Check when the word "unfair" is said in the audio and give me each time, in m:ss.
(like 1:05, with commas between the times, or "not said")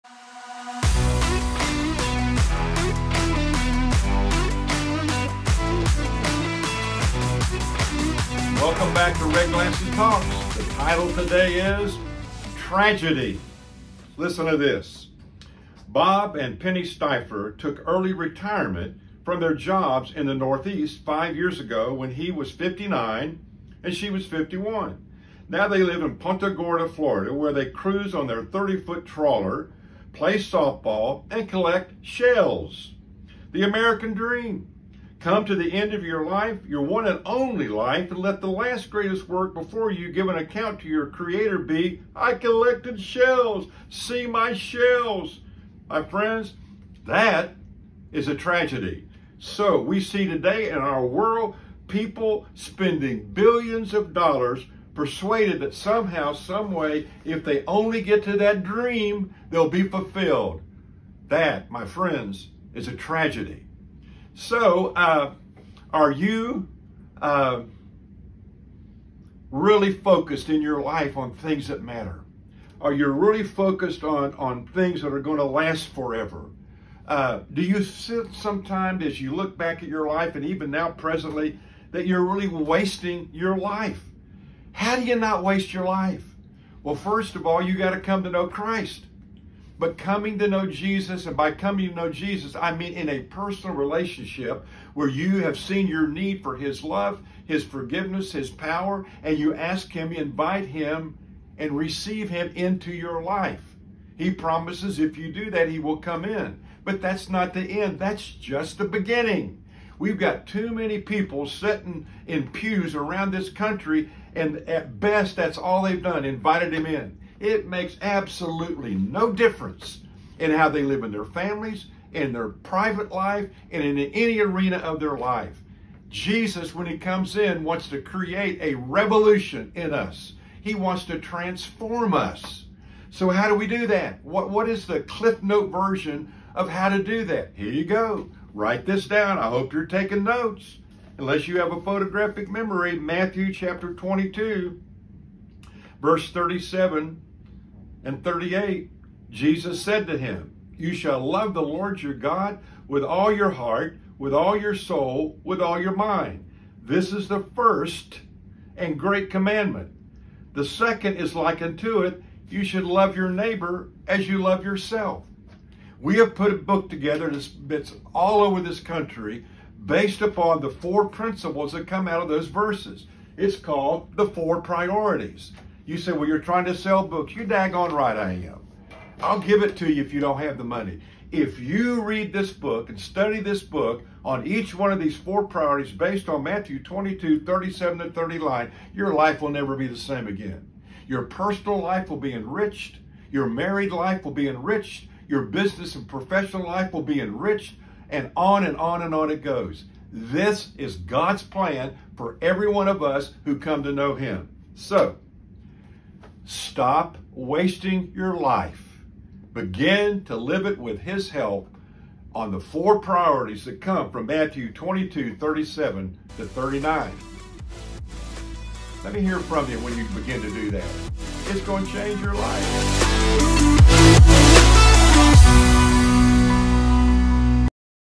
not said.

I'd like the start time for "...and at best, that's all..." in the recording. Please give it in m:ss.
1:54.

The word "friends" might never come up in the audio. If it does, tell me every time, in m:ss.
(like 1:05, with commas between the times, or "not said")
0:46, 1:01.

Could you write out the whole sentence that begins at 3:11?
Your personal life will be enriched.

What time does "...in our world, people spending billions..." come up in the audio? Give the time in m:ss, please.
0:50.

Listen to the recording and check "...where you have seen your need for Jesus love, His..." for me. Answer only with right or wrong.
wrong.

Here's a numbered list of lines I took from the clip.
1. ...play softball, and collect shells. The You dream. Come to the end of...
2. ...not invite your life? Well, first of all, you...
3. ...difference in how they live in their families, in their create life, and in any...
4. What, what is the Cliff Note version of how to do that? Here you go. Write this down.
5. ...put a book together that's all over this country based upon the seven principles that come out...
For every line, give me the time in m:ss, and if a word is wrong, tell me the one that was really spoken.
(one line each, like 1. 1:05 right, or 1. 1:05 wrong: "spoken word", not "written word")
1. 0:30 wrong: "American", not "You"
2. 1:25 wrong: "waste", not "invite"
3. 1:59 wrong: "private", not "create"
4. 2:14 right
5. 2:46 wrong: "four", not "seven".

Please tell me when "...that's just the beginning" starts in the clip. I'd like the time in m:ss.
1:47.